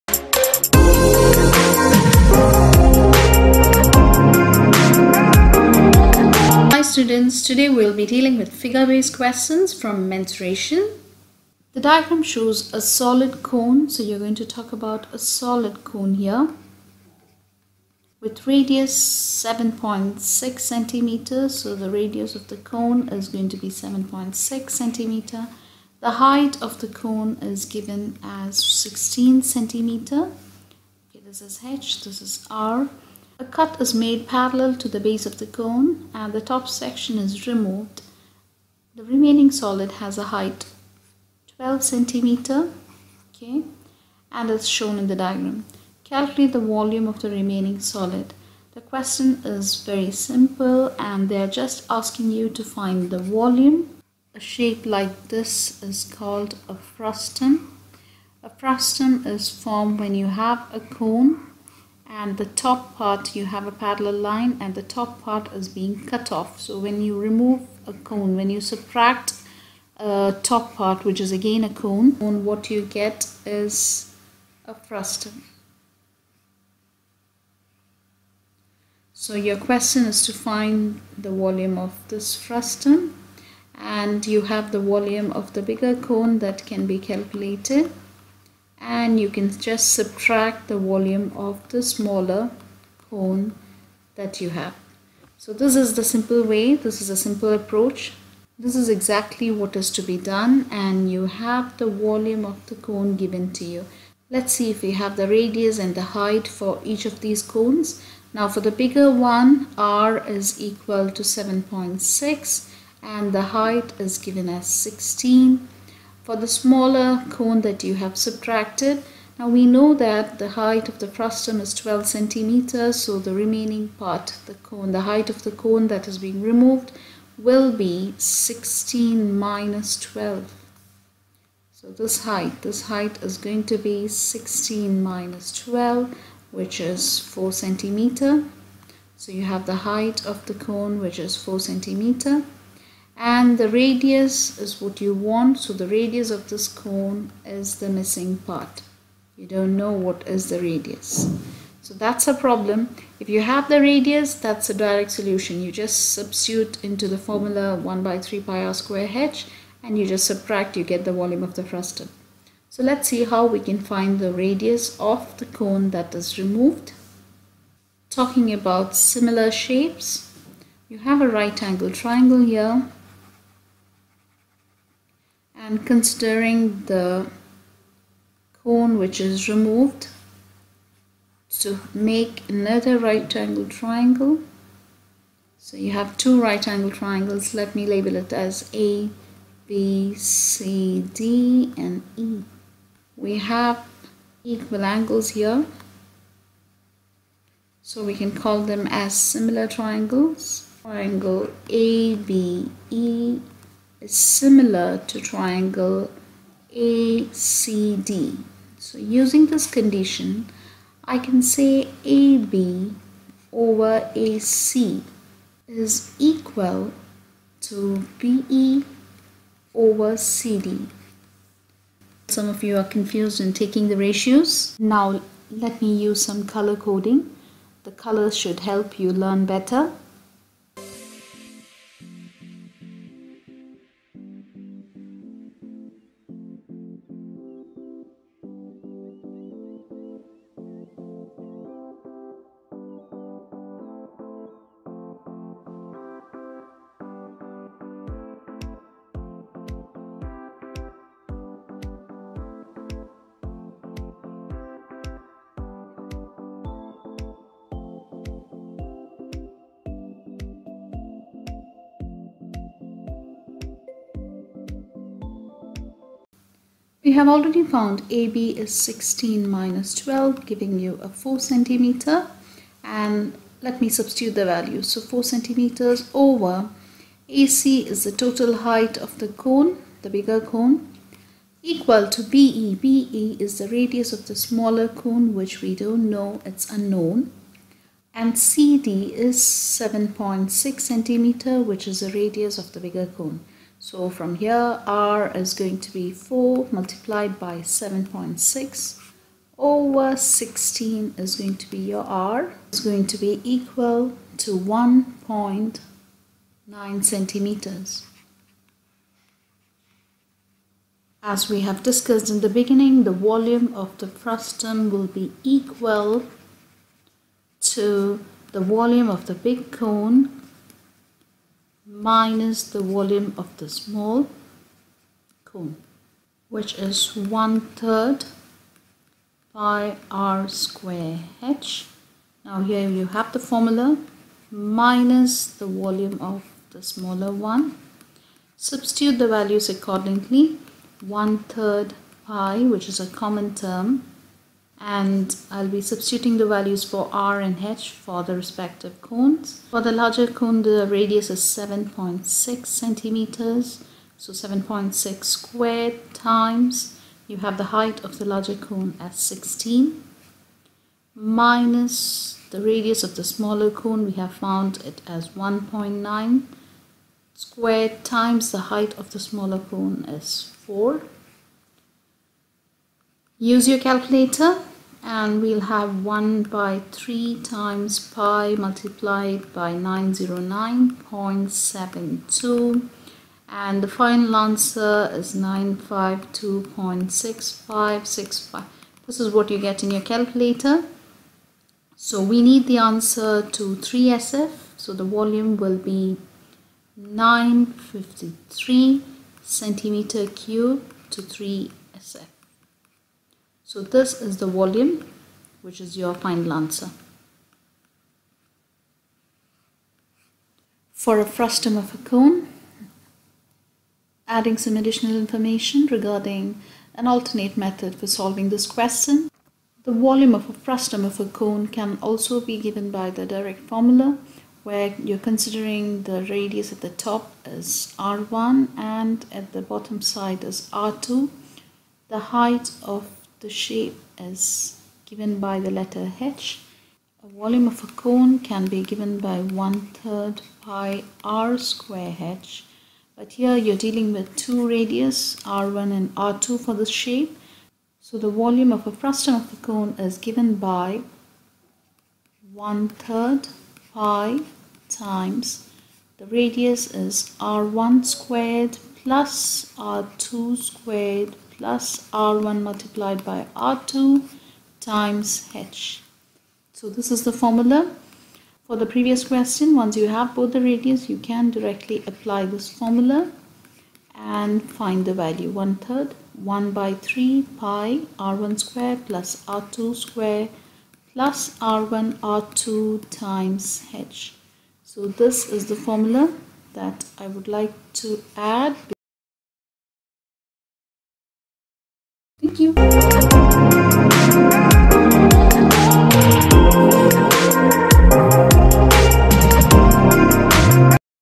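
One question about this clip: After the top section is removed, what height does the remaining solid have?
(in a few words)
12 centimeters.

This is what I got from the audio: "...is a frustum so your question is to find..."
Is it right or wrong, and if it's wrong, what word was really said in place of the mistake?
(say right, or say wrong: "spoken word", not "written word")
right.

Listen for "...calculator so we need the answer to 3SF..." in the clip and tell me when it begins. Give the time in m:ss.
6:30.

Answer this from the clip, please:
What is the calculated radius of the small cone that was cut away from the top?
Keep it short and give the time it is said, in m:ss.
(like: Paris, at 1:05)
1.9 centimeters, at 5:04.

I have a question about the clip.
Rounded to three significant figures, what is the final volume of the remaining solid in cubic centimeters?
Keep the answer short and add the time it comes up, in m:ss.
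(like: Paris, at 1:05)
953, at 6:36.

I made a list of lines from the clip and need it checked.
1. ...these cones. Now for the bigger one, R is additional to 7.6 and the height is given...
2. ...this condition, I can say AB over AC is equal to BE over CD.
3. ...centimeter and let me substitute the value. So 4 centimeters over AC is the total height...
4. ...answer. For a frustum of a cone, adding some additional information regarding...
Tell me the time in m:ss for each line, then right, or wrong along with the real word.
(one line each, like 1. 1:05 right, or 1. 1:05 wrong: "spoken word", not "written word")
1. 1:47 wrong: "equal", not "additional"
2. 3:29 right
3. 4:31 right
4. 6:46 right.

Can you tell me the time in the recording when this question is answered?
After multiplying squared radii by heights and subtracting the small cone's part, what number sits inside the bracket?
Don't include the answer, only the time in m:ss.
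6:19.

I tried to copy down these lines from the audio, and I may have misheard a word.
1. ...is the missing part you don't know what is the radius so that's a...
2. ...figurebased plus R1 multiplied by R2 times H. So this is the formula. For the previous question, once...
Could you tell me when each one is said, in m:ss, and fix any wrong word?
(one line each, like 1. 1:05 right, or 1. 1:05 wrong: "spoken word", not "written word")
1. 2:27 right
2. 7:40 wrong: "squared", not "figurebased".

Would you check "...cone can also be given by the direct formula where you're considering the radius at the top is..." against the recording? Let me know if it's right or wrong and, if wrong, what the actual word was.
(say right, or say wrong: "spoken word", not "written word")
right.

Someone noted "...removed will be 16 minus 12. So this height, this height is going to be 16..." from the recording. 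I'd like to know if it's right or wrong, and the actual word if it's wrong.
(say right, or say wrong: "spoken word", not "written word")
right.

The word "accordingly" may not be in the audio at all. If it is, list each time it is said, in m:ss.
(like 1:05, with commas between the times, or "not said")
5:39.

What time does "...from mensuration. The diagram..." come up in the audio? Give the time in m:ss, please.
0:09.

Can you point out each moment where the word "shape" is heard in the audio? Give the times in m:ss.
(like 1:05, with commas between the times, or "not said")
0:54, 2:49, 7:13, 7:26.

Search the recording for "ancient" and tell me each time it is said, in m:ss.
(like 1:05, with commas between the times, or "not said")
not said.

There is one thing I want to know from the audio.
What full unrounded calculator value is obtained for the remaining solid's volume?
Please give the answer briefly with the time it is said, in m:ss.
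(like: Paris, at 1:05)
952.6565, at 6:25.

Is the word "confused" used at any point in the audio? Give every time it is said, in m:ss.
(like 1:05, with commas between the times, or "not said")
3:42.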